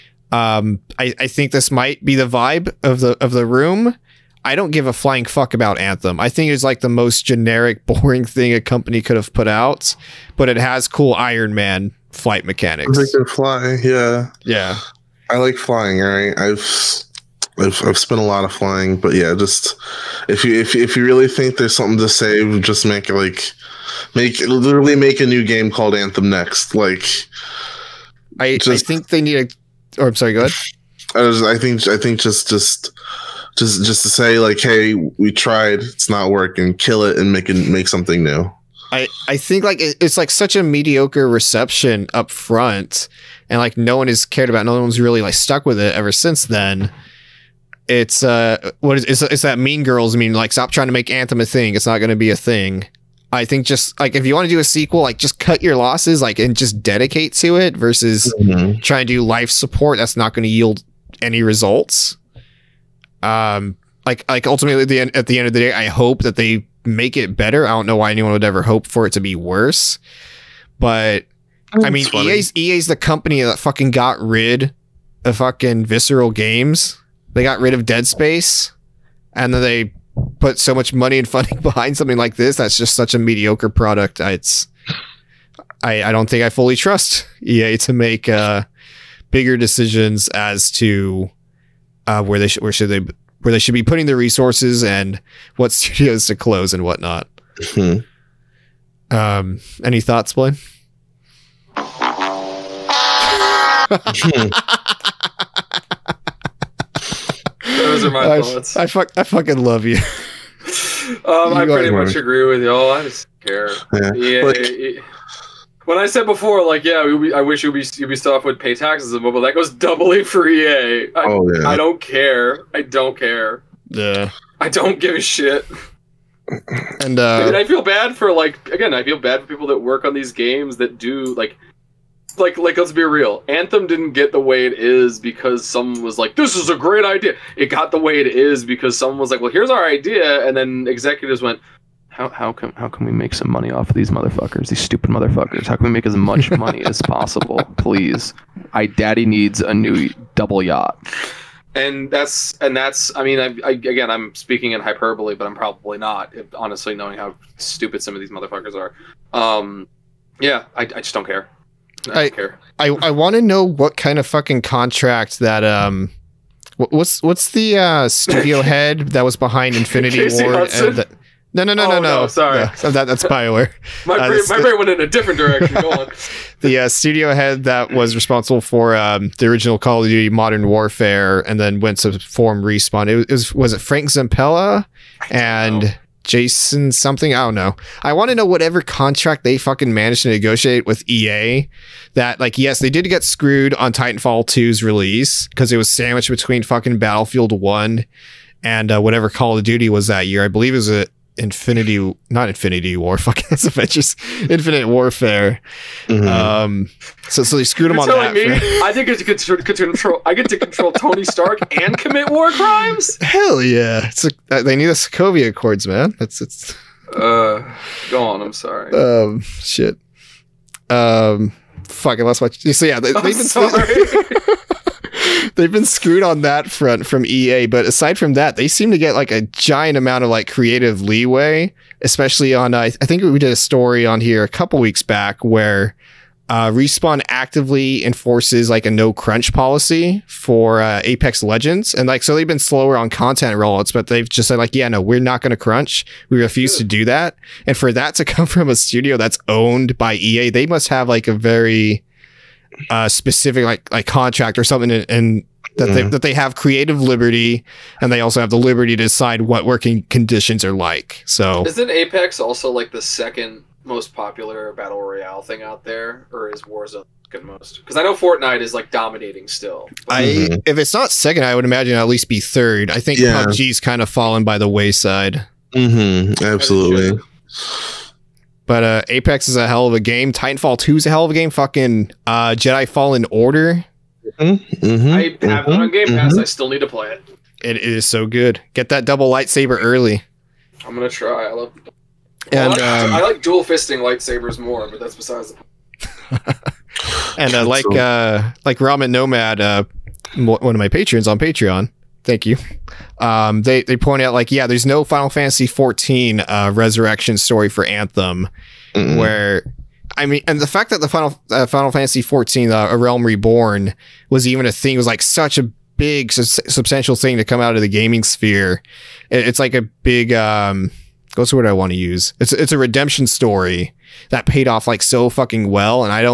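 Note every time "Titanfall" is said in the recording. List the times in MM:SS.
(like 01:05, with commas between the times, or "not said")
03:13, 04:40.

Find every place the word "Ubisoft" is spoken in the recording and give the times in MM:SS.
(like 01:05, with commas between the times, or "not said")
01:57.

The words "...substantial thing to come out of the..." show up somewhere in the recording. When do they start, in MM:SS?
05:16.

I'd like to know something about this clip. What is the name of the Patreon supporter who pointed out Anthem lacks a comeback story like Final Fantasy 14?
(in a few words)
Ramen Nomad.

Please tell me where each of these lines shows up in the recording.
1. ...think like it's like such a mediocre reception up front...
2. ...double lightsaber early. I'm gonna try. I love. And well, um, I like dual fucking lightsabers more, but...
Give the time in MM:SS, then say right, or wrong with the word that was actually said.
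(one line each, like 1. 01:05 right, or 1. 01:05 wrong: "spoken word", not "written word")
1. 00:39 right
2. 04:49 wrong: "fisting", not "fucking".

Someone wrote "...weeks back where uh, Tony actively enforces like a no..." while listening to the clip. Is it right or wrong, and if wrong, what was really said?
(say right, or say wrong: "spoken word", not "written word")
wrong: "Respawn", not "Tony".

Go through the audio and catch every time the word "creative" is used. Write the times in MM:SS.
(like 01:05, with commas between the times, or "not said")
03:50, 04:16.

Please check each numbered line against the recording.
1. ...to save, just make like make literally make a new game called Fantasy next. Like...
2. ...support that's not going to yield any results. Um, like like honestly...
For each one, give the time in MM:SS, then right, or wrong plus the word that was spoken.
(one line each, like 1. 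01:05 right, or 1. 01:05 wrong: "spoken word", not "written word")
1. 00:21 wrong: "Anthem", not "Fantasy"
2. 00:59 wrong: "ultimately", not "honestly".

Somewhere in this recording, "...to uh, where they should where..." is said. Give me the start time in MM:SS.
01:30.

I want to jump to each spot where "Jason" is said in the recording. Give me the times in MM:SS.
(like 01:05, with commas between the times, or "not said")
03:06.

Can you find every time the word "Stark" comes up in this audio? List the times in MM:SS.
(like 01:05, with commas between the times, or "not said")
03:31.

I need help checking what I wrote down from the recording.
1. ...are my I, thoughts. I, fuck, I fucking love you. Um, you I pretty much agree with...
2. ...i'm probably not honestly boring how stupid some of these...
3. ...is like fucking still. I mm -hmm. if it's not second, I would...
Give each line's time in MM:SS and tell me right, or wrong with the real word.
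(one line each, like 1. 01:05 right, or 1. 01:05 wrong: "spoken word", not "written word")
1. 01:48 right
2. 02:35 wrong: "knowing", not "boring"
3. 04:28 wrong: "dominating", not "fucking".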